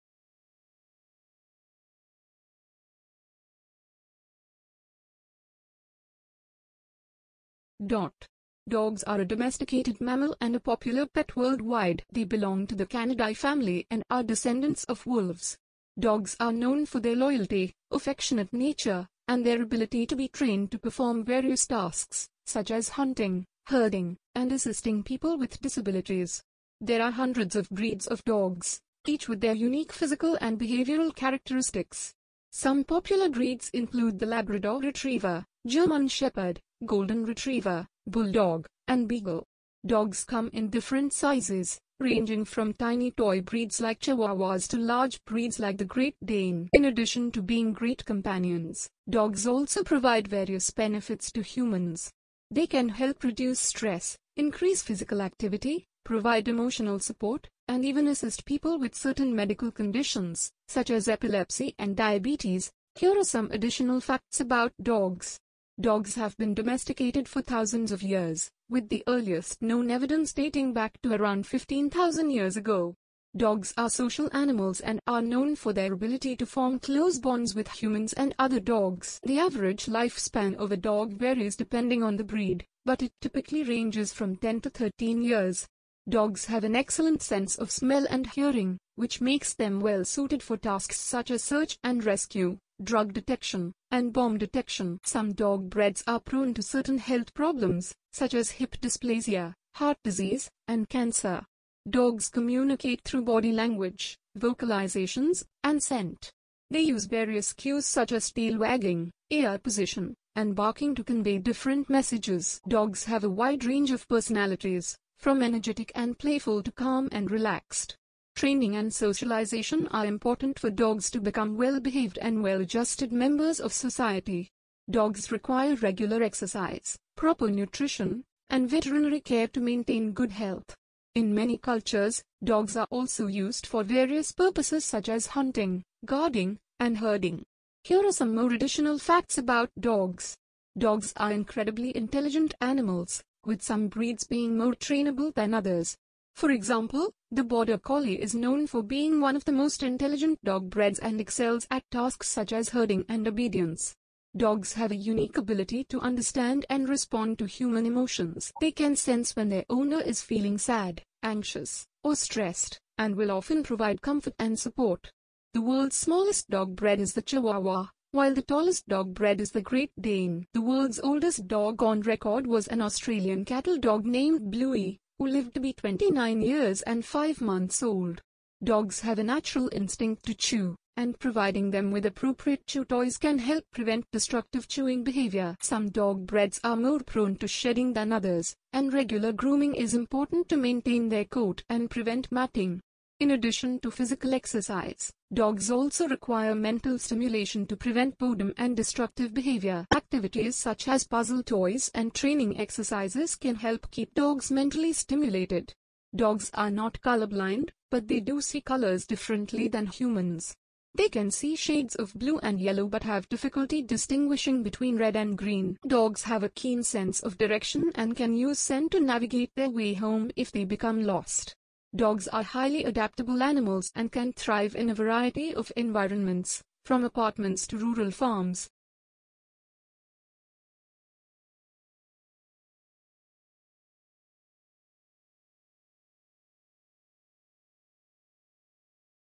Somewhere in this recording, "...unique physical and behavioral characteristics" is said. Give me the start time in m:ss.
0:29.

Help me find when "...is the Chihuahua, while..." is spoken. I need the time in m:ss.
2:46.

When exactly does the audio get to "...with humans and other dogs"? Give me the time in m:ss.
1:17.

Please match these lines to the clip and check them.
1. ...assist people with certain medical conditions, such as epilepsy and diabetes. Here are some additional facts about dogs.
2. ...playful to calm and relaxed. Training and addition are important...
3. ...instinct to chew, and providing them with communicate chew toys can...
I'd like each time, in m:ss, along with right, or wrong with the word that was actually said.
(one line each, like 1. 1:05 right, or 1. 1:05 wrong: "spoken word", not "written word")
1. 0:58 right
2. 1:56 wrong: "socialization", not "addition"
3. 2:59 wrong: "appropriate", not "communicate".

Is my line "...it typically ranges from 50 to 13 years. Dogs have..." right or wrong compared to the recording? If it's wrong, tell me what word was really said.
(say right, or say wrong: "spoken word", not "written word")
wrong: "10", not "50".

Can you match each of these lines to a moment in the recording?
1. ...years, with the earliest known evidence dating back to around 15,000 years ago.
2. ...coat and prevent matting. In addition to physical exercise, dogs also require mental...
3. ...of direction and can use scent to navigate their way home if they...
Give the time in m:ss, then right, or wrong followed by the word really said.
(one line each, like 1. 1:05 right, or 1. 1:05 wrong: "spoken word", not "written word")
1. 1:08 right
2. 3:11 right
3. 3:37 right.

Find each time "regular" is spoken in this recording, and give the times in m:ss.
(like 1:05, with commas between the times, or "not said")
2:05, 3:08.